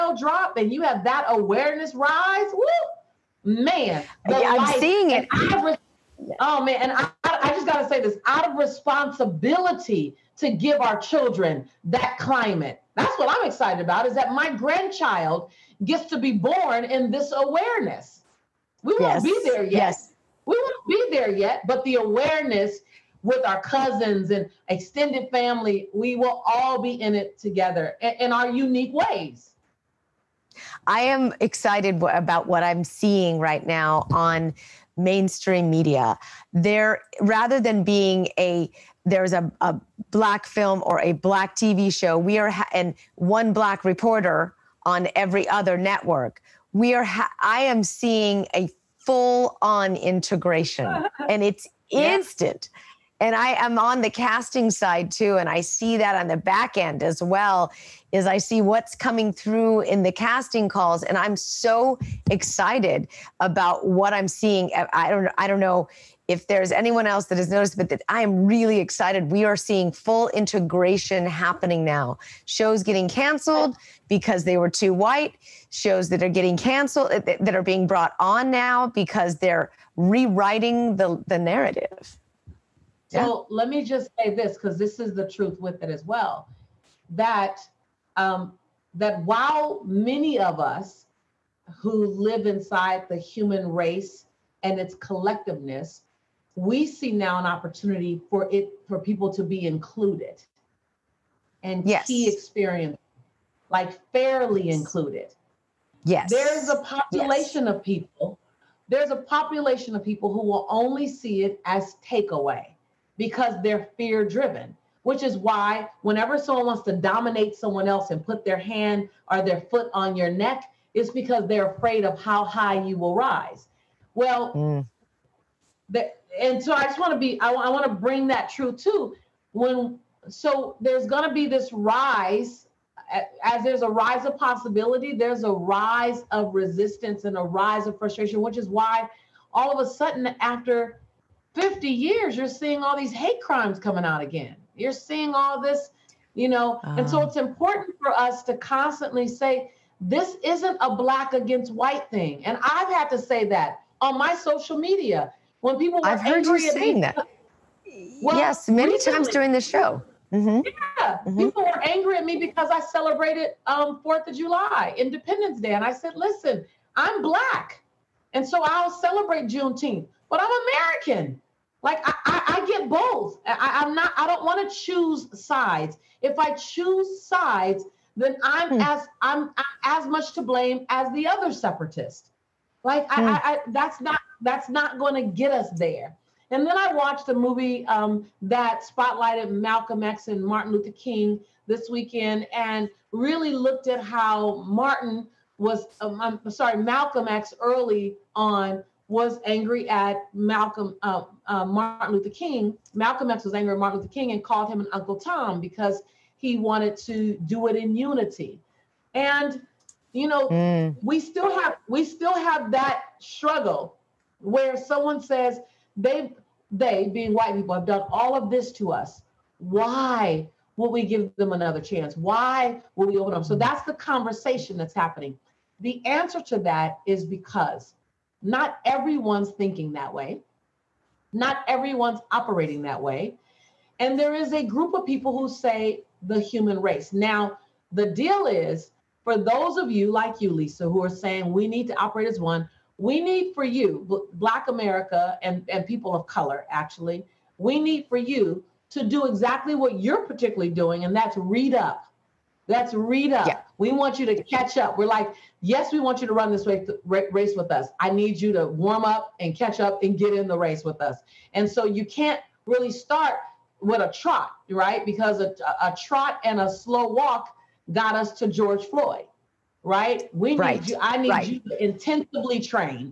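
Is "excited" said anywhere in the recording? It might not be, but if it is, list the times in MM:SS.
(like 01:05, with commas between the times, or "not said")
00:13, 00:31, 01:02, 01:08.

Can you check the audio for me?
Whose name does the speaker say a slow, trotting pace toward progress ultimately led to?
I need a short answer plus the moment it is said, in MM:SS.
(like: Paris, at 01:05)
George Floyd, at 04:28.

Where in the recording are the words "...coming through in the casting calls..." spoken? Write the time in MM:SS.
00:58.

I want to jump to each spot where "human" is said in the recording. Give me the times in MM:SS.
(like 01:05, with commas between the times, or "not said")
01:33, 03:56.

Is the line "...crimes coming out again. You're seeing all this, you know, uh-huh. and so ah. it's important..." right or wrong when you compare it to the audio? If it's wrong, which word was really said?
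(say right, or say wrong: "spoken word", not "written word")
right.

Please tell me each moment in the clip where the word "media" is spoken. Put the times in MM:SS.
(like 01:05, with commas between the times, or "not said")
00:35, 02:34.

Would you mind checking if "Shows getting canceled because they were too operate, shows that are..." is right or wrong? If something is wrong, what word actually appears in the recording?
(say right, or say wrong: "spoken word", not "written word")
wrong: "white", not "operate".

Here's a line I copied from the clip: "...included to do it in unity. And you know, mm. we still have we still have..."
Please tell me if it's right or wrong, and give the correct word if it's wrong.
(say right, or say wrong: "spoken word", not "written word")
wrong: "wanted", not "included".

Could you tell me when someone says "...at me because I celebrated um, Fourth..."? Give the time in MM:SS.
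02:42.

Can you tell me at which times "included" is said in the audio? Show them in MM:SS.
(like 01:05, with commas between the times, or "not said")
01:39, 01:44.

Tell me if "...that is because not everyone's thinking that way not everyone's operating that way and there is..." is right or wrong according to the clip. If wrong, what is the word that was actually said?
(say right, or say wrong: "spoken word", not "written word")
right.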